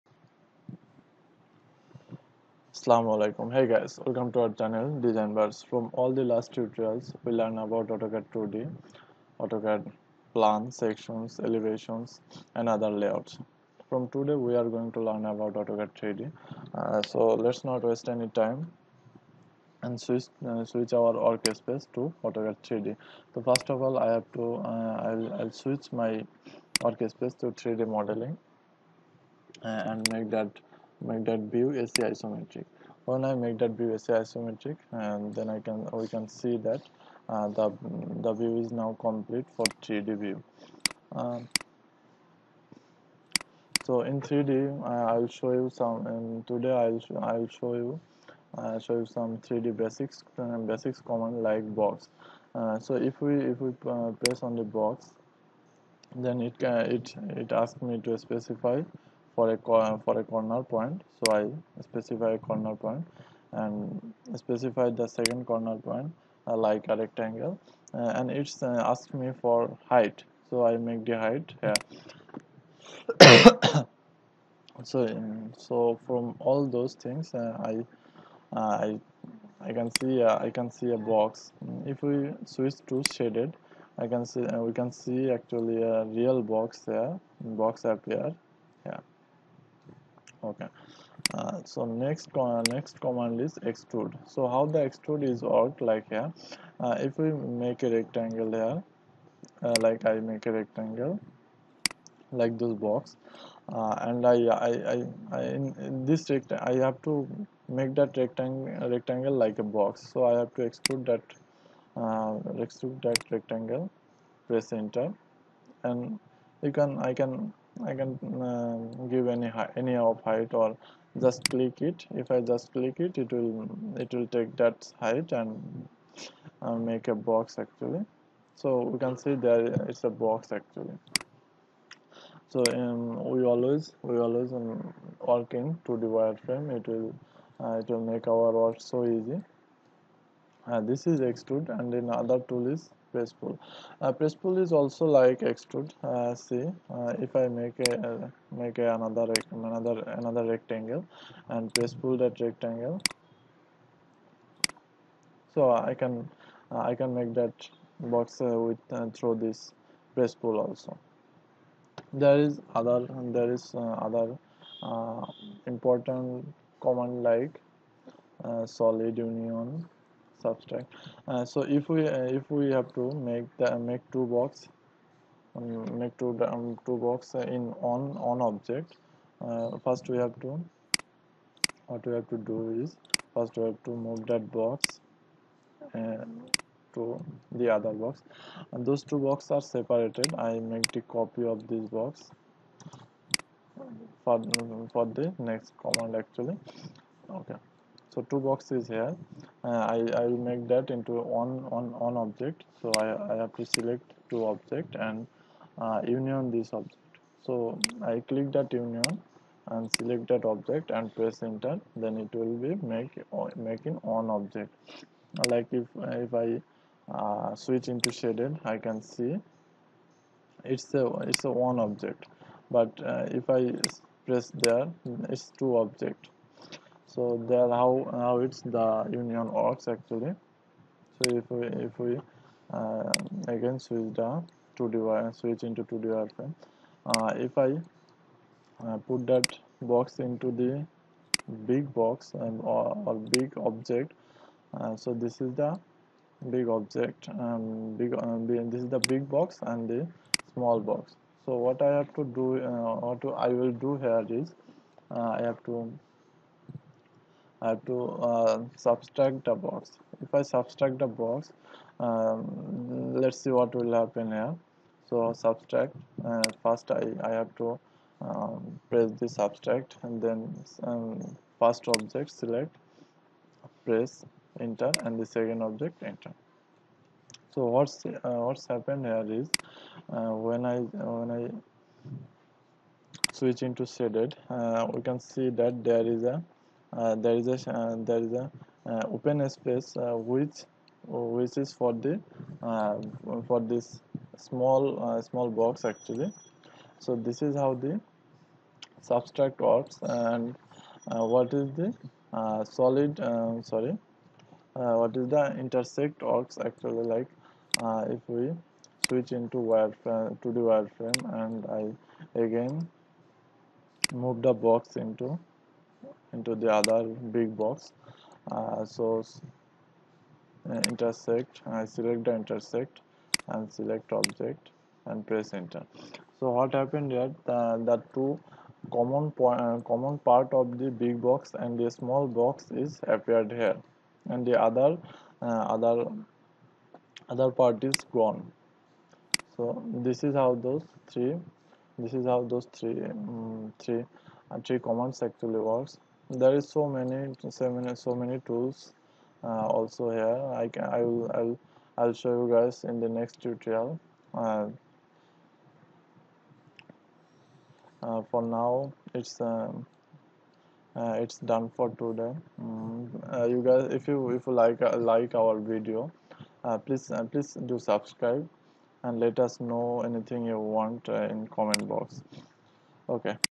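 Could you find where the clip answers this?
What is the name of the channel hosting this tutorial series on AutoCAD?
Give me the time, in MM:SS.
00:05.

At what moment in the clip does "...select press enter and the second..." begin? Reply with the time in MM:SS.
04:32.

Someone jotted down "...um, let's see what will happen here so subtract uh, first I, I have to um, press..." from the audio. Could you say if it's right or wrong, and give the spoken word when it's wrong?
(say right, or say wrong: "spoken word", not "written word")
right.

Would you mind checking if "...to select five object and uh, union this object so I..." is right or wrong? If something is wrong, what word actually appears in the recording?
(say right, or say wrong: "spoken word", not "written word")
wrong: "two", not "five".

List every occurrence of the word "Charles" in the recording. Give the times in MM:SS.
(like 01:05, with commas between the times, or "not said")
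not said.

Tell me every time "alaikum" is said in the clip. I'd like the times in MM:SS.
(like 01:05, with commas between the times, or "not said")
00:03.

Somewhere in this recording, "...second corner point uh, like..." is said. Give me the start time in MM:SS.
01:05.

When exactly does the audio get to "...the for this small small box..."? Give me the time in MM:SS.
04:51.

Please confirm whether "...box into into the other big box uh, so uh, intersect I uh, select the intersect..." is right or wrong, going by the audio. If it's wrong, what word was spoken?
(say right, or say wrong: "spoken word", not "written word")
right.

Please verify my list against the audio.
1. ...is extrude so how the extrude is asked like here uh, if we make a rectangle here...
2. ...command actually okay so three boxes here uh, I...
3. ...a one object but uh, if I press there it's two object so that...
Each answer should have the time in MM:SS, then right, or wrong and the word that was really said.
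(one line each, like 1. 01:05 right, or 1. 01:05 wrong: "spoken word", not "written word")
1. 01:33 wrong: "worked", not "asked"
2. 03:15 wrong: "two", not "three"
3. 03:41 right.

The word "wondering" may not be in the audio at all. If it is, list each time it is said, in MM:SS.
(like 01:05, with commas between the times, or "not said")
not said.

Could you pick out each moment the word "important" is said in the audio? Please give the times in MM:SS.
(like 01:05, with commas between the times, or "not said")
02:45.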